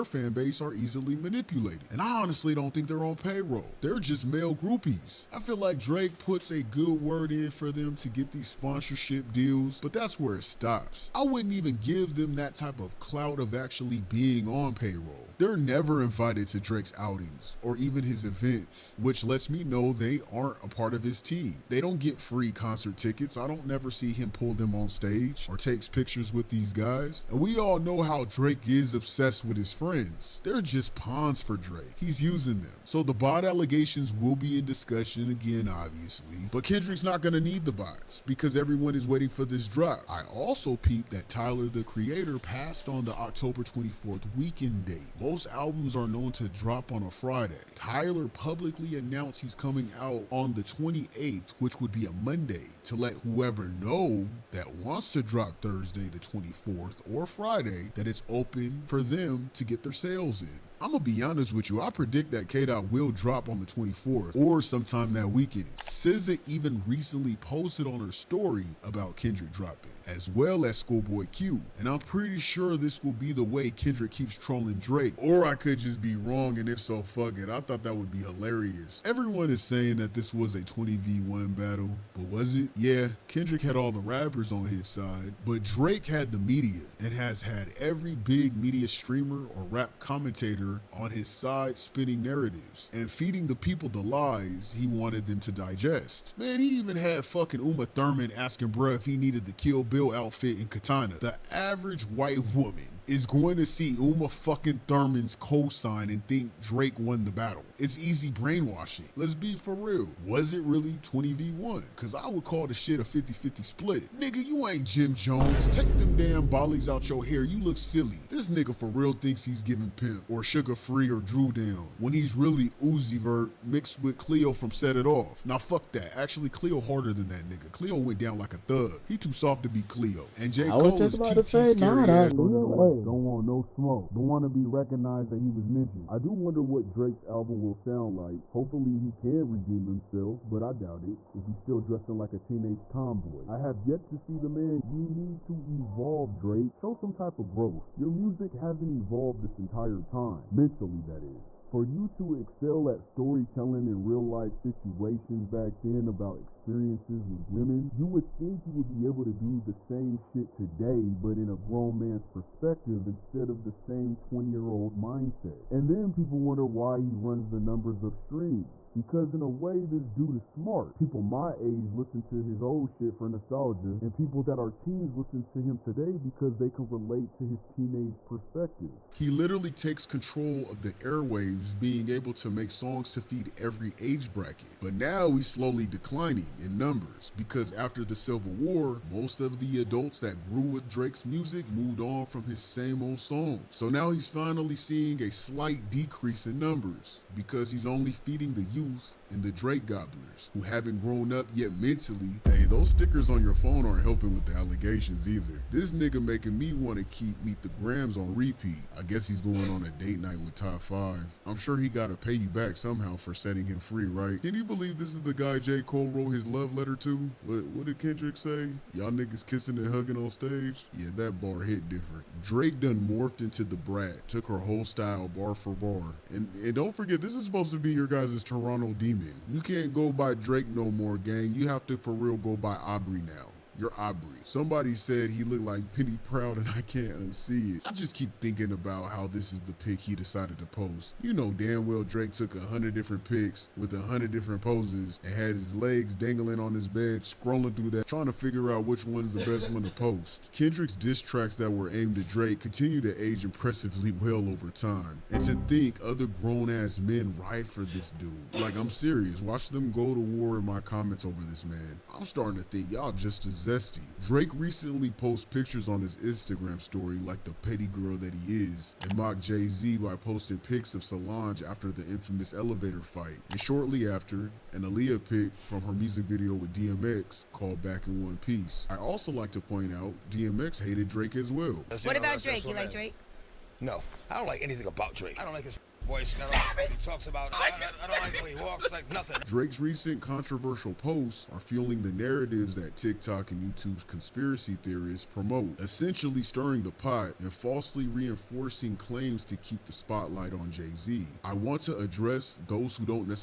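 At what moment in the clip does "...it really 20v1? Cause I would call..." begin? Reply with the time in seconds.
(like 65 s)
110 s.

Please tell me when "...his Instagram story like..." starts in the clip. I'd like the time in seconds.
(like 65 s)
265 s.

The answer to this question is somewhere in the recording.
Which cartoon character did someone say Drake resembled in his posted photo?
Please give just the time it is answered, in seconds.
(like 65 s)
235 s.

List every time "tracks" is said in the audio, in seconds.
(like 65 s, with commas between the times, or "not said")
251 s.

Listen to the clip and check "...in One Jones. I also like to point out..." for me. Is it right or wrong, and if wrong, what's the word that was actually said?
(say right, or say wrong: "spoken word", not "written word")
wrong: "Piece", not "Jones".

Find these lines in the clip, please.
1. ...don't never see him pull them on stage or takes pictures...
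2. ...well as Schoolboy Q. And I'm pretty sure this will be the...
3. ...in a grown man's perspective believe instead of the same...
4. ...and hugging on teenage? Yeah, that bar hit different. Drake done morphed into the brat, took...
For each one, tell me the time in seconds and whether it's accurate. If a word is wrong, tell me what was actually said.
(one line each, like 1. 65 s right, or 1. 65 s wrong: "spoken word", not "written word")
1. 23 s right
2. 70 s right
3. 161 s wrong: "perspective", not "believe"
4. 219 s wrong: "stage", not "teenage".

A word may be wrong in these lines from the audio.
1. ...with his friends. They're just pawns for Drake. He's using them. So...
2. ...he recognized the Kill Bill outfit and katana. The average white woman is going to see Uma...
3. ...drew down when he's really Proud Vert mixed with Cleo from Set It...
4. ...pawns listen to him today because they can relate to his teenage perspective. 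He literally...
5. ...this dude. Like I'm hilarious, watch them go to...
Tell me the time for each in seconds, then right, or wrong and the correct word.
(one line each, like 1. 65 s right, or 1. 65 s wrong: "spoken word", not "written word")
1. 29 s right
2. 99 s wrong: "needed", not "recognized"
3. 121 s wrong: "Uzi", not "Proud"
4. 174 s wrong: "teens", not "pawns"
5. 257 s wrong: "serious", not "hilarious".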